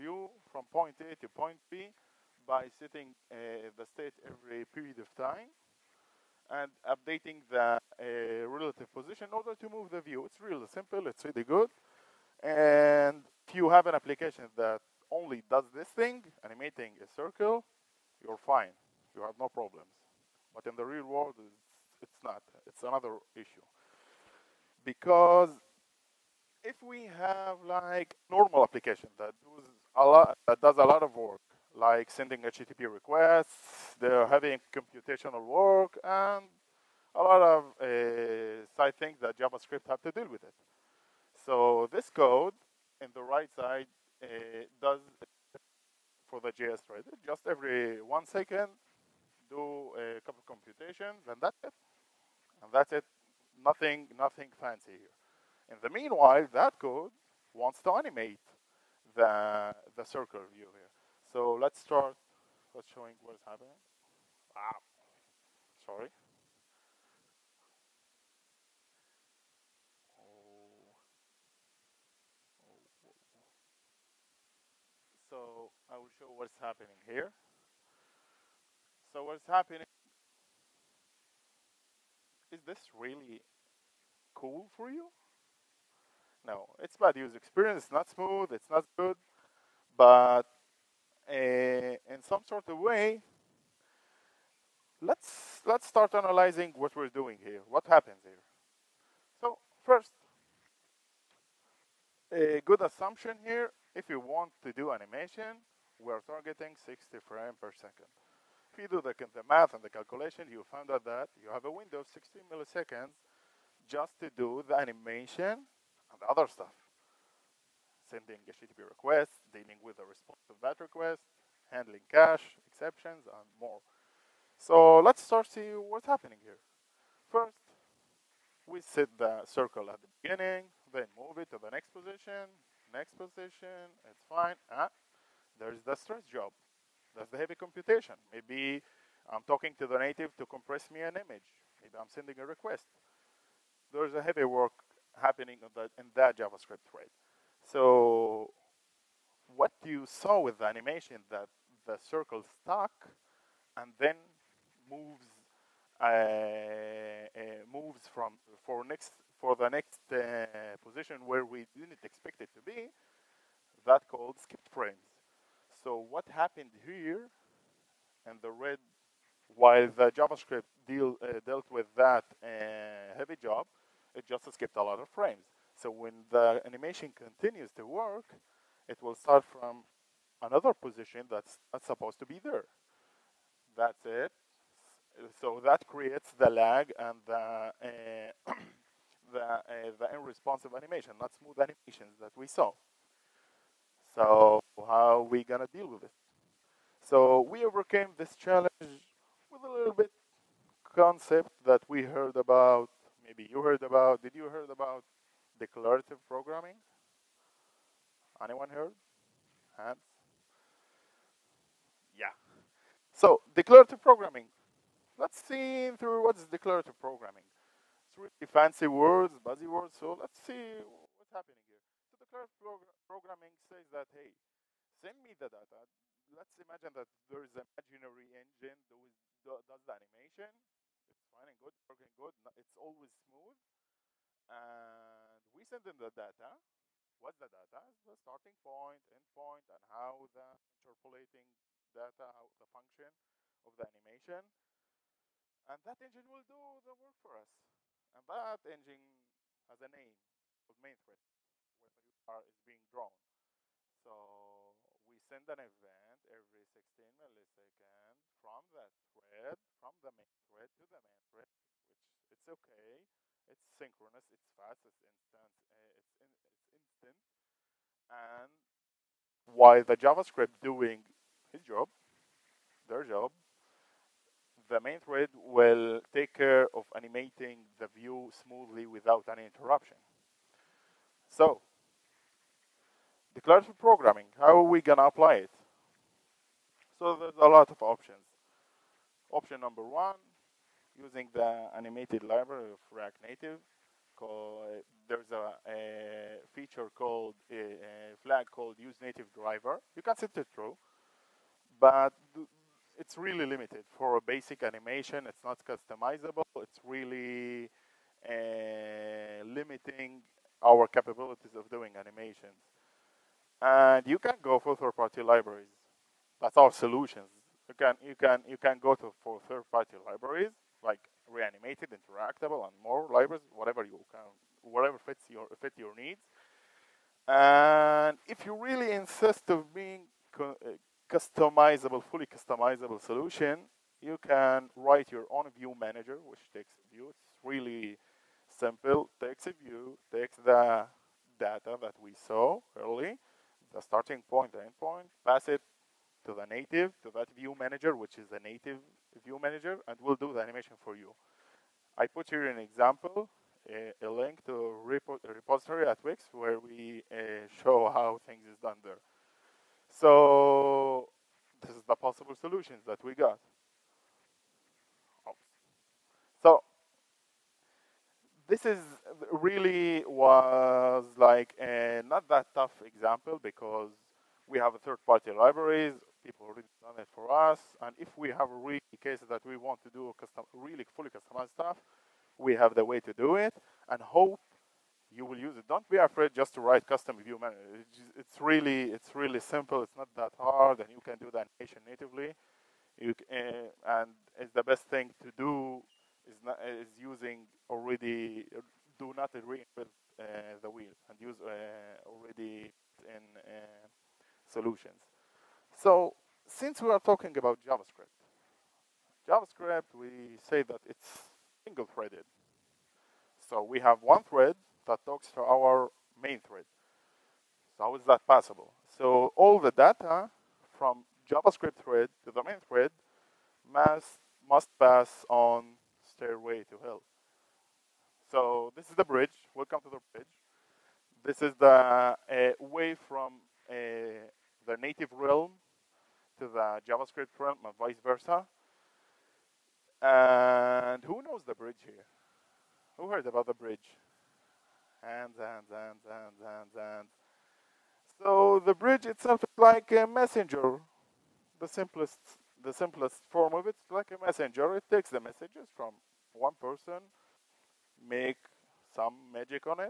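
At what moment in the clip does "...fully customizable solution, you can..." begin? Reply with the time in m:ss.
5:32.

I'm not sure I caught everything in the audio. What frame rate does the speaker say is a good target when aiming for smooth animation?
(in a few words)
60 frames per second.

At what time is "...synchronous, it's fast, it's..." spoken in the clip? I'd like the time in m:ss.
4:23.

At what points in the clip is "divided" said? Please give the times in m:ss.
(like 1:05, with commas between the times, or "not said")
not said.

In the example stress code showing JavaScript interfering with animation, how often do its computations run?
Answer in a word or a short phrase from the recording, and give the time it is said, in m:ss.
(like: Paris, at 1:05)
every one second, at 0:47.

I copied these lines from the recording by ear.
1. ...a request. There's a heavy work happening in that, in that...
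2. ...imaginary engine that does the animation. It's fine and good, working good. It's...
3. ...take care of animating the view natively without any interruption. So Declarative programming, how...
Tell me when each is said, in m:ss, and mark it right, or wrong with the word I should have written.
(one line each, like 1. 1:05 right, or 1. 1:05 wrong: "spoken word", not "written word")
1. 2:22 right
2. 3:47 right
3. 4:36 wrong: "smoothly", not "natively".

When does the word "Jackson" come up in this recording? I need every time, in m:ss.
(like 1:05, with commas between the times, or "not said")
not said.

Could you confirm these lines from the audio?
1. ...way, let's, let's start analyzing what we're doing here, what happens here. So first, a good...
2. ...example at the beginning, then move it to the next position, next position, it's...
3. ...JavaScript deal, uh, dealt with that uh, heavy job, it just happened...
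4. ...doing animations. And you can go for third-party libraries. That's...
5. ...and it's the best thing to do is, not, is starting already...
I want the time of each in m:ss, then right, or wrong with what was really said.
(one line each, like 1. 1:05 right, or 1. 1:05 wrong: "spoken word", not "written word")
1. 1:32 right
2. 2:09 wrong: "circle", not "example"
3. 2:50 wrong: "skipped", not "happened"
4. 5:11 right
5. 6:34 wrong: "using", not "starting".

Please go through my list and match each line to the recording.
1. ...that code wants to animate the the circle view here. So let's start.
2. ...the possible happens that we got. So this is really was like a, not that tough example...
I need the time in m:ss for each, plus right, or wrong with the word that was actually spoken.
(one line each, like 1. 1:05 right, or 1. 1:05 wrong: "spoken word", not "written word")
1. 0:56 right
2. 6:01 wrong: "solutions", not "happens".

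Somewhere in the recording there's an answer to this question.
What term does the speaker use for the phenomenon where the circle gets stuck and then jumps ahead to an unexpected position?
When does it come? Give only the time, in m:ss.
2:44.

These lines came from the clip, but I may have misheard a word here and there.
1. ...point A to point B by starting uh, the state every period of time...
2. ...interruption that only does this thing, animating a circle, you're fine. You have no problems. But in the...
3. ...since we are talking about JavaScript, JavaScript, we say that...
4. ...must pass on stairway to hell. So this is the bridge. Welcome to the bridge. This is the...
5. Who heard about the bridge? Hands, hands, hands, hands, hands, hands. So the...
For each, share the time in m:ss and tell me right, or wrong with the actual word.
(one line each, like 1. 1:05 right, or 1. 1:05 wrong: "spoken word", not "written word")
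1. 0:00 wrong: "setting", not "starting"
2. 0:13 wrong: "application", not "interruption"
3. 6:46 right
4. 7:04 right
5. 7:22 right.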